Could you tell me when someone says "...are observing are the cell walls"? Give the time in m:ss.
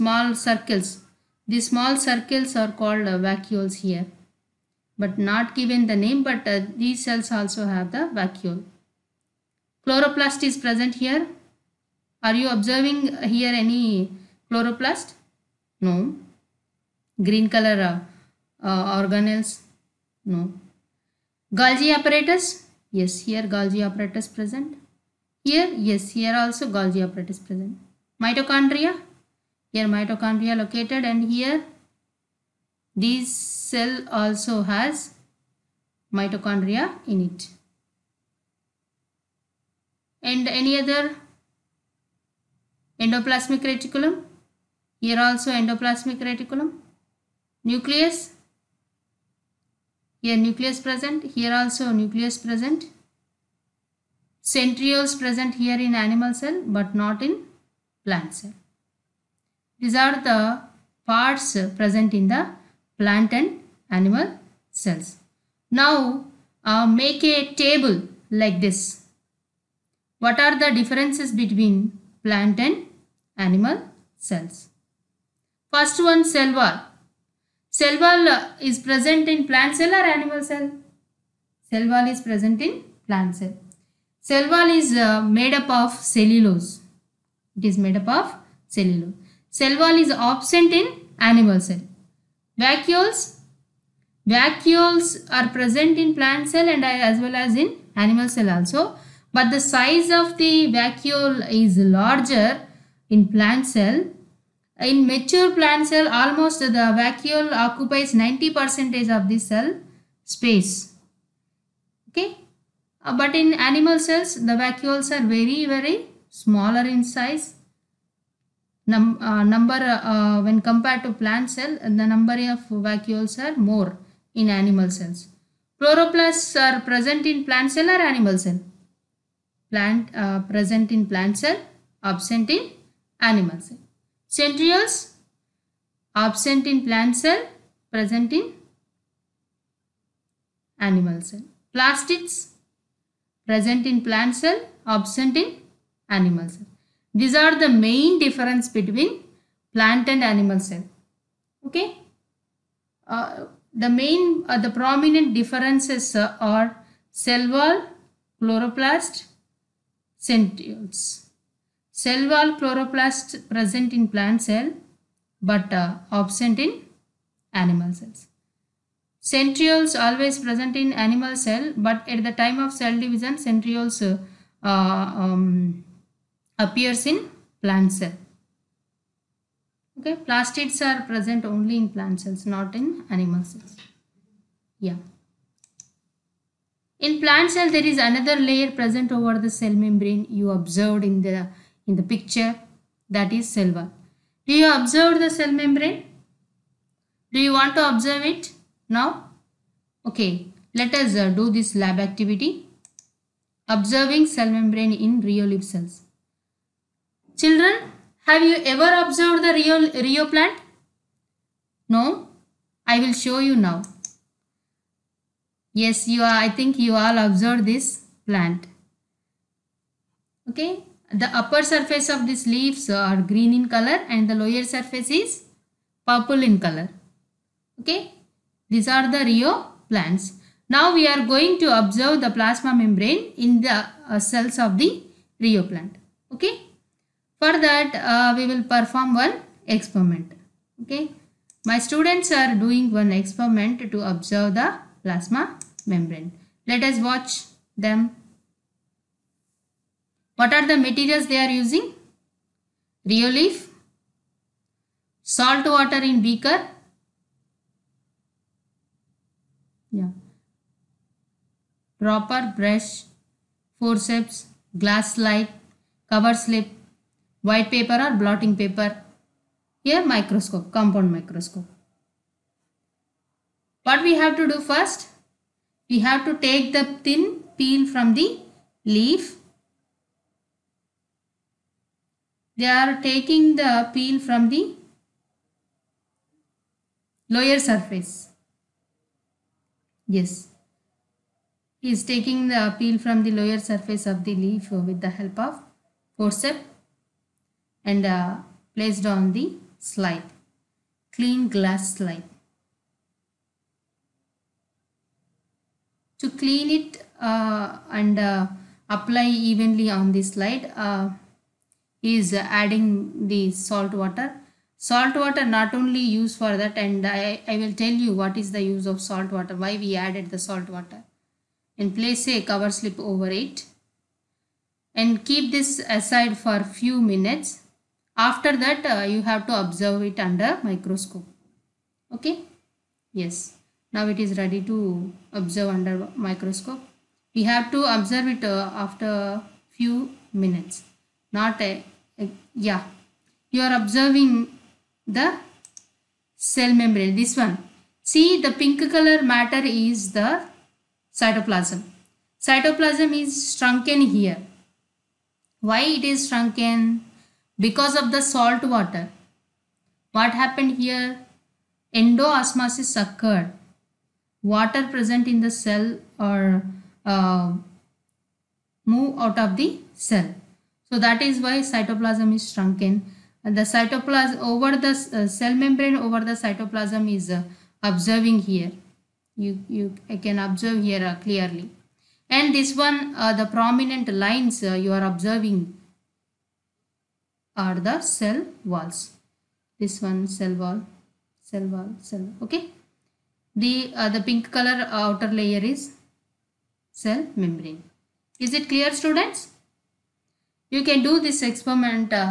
6:24.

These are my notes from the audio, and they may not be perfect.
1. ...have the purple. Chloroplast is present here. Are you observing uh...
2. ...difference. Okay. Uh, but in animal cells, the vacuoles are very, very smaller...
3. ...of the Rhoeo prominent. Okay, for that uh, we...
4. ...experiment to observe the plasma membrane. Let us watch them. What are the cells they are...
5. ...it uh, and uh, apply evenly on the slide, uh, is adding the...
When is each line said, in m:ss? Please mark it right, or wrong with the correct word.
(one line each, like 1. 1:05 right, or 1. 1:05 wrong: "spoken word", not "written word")
1. 0:07 wrong: "vacuole", not "purple"
2. 1:50 wrong: "space", not "difference"
3. 3:54 wrong: "plant", not "prominent"
4. 4:03 wrong: "materials", not "cells"
5. 5:06 right.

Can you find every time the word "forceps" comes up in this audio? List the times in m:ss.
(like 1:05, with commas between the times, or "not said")
4:23, 4:56.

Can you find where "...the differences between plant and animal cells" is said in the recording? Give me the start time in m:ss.
1:10.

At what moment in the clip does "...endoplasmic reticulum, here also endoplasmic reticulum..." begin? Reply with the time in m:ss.
0:43.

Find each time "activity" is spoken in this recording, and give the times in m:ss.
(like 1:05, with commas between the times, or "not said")
3:21.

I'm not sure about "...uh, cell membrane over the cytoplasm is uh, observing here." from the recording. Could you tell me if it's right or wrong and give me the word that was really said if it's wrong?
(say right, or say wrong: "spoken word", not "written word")
right.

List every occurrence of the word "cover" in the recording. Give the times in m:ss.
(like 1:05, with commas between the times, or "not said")
4:26, 5:22.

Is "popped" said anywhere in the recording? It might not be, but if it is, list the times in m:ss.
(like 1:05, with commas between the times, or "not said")
not said.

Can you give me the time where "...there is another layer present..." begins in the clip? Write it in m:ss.
3:07.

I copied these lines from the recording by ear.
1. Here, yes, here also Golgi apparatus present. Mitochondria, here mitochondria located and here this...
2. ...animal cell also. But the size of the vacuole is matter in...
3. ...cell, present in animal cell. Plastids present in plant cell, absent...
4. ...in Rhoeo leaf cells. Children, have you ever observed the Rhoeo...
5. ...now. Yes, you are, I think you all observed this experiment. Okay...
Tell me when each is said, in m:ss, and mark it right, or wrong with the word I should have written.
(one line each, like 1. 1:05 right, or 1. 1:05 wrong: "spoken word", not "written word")
1. 0:25 right
2. 1:37 wrong: "larger", not "matter"
3. 2:17 right
4. 3:24 right
5. 3:33 wrong: "plant", not "experiment".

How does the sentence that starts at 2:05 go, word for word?
Chloroplasts are present in plant cell or animal cell?